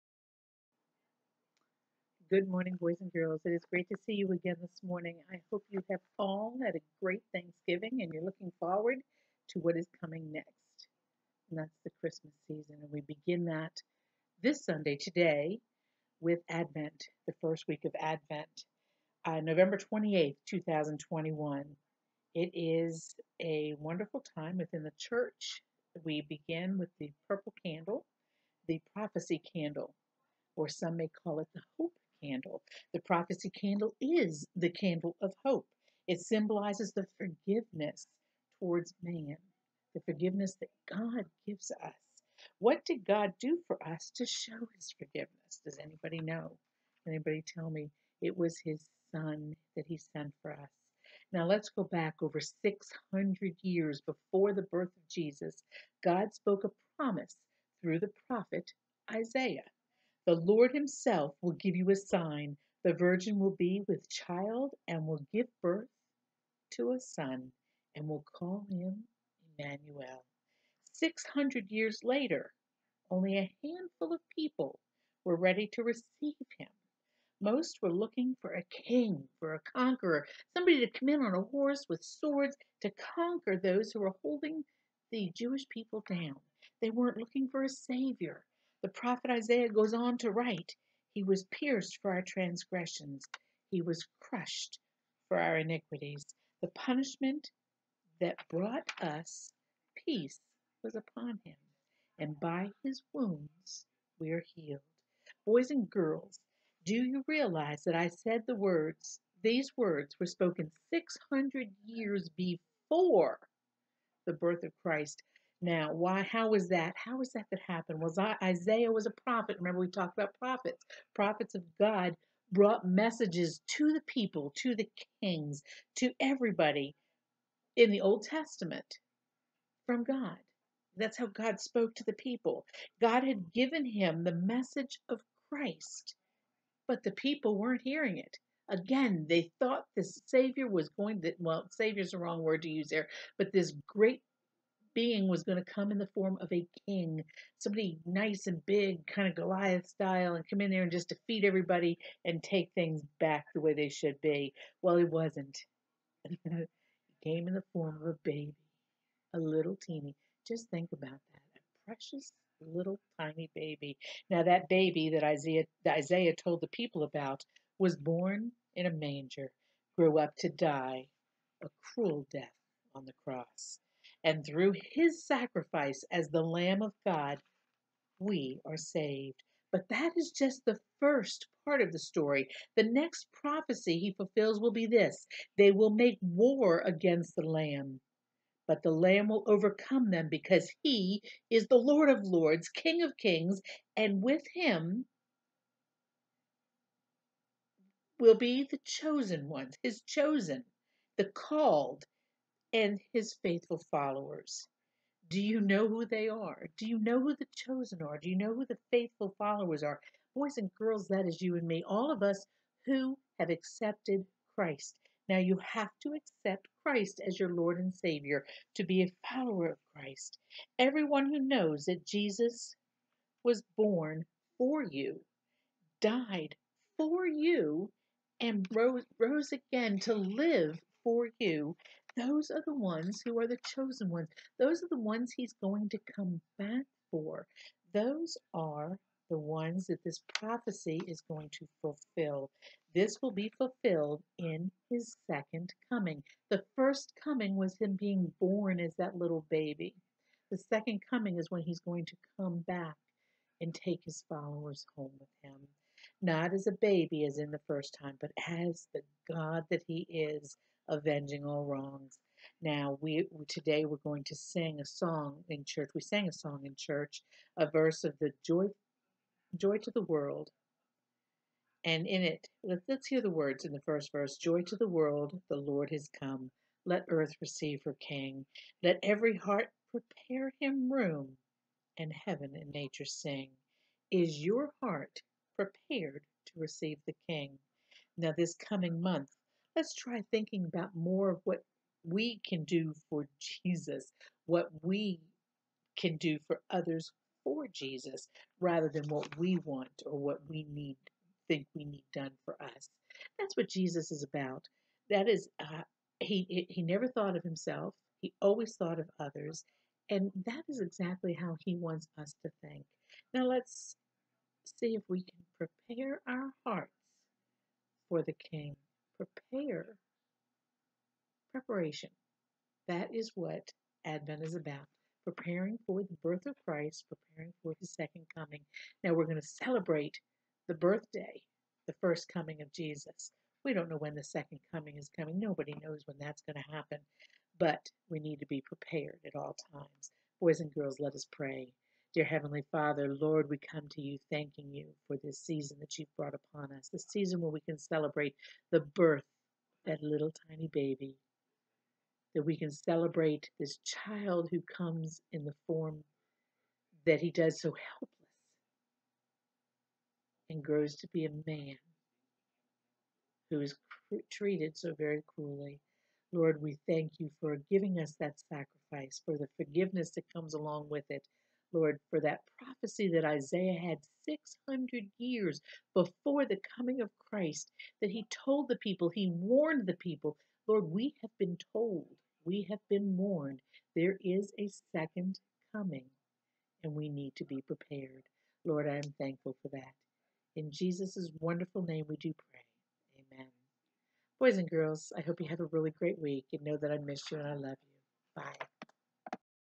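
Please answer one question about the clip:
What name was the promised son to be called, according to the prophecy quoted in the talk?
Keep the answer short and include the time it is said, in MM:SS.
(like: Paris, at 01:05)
Emmanuel, at 01:09.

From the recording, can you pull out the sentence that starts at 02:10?
That's how God spoke to the people.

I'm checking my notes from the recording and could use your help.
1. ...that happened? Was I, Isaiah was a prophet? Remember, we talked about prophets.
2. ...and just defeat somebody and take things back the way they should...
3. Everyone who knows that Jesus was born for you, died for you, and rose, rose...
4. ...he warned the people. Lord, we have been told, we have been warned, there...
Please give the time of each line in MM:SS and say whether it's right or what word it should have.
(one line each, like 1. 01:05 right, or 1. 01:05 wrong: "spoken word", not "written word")
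1. 01:57 right
2. 02:30 wrong: "everybody", not "somebody"
3. 03:40 right
4. 06:19 right.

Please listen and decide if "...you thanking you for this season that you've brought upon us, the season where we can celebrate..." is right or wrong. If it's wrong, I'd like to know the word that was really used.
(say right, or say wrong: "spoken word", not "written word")
right.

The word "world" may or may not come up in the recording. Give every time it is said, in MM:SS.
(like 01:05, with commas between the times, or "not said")
04:30, 04:34.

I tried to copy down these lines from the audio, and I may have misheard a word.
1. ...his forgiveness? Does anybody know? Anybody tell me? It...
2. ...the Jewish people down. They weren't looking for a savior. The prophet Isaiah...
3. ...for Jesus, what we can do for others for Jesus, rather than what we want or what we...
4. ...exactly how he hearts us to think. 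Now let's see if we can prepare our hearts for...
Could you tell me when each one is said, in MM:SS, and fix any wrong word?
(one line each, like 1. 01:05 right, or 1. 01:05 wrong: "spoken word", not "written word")
1. 00:44 right
2. 01:25 right
3. 04:53 right
4. 05:10 wrong: "wants", not "hearts".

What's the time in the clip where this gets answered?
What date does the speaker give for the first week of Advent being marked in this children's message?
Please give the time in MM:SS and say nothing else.
00:19.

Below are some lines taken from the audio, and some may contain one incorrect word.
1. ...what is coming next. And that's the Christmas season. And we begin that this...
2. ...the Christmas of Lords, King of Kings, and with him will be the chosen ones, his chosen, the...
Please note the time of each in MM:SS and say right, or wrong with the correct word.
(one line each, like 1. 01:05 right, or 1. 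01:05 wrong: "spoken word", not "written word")
1. 00:09 right
2. 03:11 wrong: "Lord", not "Christmas".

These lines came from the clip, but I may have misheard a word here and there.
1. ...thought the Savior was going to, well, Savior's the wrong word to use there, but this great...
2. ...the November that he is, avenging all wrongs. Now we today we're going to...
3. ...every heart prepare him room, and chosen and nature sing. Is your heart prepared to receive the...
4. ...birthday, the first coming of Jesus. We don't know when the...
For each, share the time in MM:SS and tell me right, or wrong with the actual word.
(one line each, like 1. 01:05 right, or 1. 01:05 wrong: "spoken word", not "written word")
1. 02:19 right
2. 04:18 wrong: "God", not "November"
3. 04:39 wrong: "heaven", not "chosen"
4. 05:30 right.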